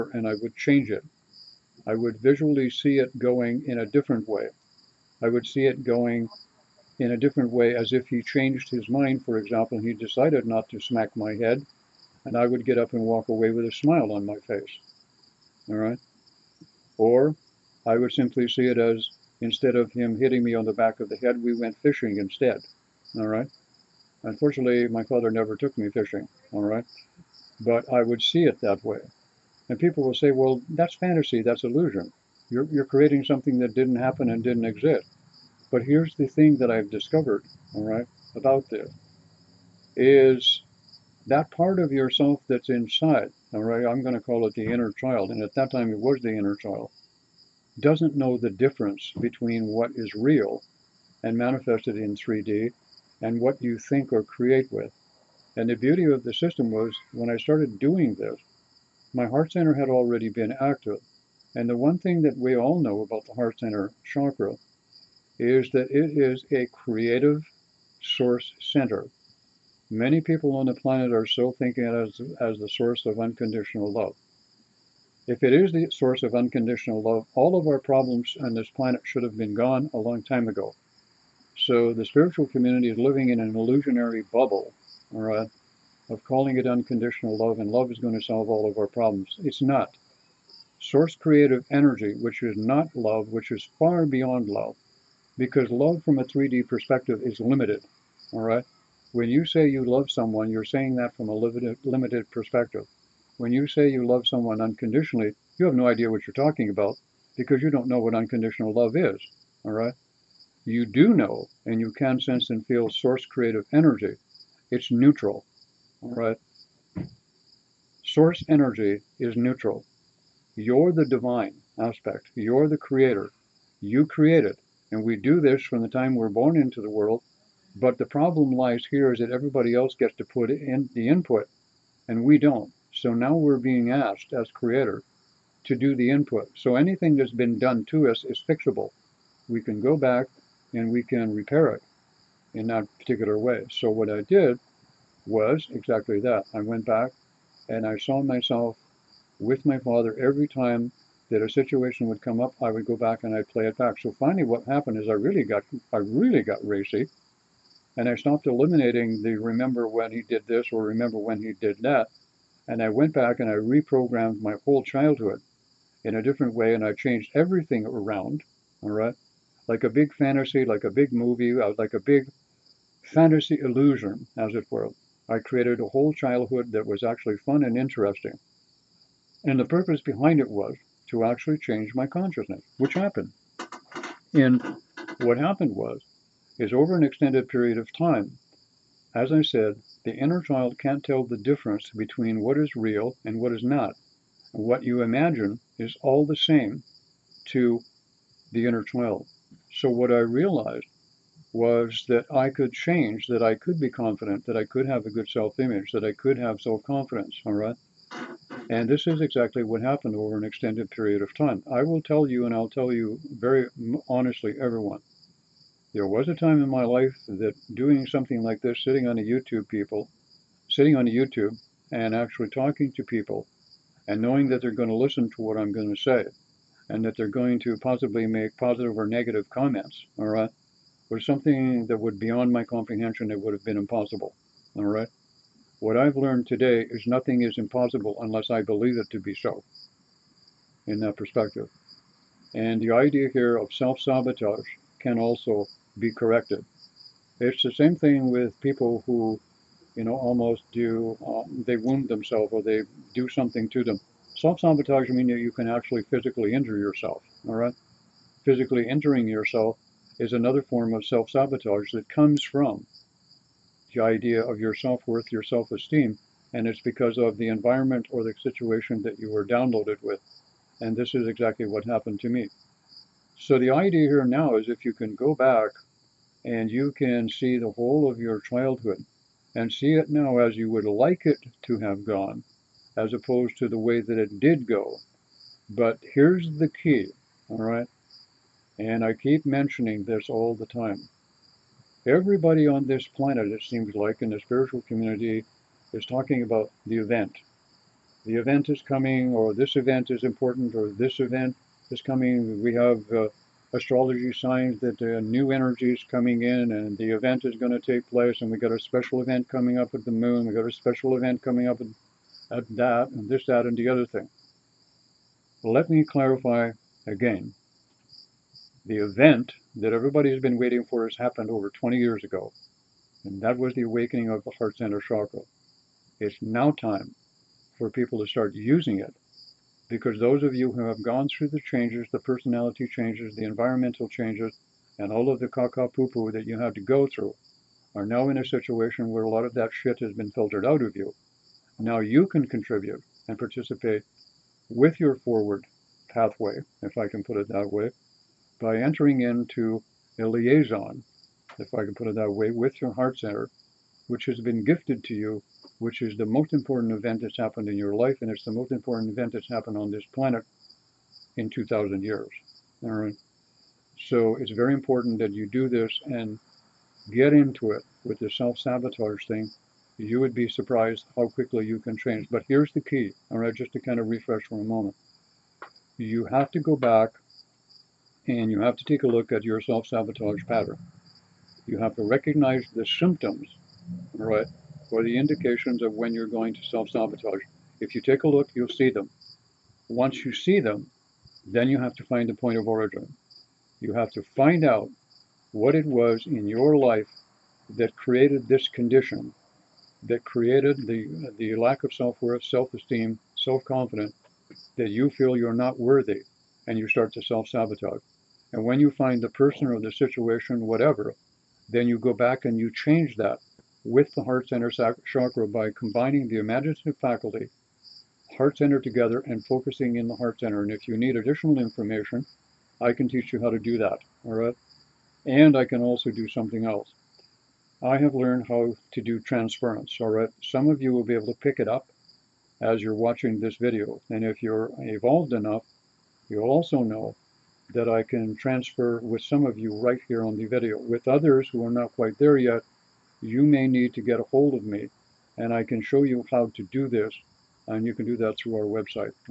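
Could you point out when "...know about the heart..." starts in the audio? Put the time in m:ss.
1:02.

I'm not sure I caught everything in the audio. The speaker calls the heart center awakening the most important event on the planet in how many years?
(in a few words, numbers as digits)
2,000 years.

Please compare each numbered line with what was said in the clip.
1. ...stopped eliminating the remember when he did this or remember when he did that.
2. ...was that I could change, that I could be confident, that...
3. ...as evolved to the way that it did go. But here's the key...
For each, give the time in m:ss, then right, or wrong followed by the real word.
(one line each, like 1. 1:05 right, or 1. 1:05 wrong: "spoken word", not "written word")
1. 2:38 right
2. 3:21 right
3. 4:42 wrong: "opposed", not "evolved".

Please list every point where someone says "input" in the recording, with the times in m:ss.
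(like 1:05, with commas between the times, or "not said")
2:11, 2:16.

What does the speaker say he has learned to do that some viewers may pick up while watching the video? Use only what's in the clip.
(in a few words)
transference.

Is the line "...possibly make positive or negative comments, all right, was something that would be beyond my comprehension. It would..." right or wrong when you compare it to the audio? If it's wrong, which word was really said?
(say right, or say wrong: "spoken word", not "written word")
right.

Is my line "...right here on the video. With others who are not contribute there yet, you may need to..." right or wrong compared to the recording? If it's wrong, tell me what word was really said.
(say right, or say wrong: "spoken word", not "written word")
wrong: "quite", not "contribute".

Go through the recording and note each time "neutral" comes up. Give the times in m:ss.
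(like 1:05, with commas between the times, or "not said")
1:54, 1:59.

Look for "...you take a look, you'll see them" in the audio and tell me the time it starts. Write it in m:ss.
6:27.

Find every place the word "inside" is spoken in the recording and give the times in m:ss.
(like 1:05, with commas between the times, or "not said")
0:42.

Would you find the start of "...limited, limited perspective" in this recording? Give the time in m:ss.
1:41.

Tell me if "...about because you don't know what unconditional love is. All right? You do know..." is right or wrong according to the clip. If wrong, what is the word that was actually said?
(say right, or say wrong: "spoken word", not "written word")
right.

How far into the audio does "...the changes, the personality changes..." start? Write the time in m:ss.
5:31.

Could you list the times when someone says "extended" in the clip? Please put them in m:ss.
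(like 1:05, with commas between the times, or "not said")
3:07, 3:30.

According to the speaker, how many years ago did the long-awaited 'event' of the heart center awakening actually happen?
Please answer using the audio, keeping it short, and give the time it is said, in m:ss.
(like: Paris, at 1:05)
over 20 years, at 5:21.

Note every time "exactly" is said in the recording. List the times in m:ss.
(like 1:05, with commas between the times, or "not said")
2:25, 3:29, 4:31.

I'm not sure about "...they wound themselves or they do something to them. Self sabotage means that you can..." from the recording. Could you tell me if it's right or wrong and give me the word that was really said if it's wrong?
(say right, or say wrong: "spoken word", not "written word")
right.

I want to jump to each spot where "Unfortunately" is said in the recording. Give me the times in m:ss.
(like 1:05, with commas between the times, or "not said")
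0:24.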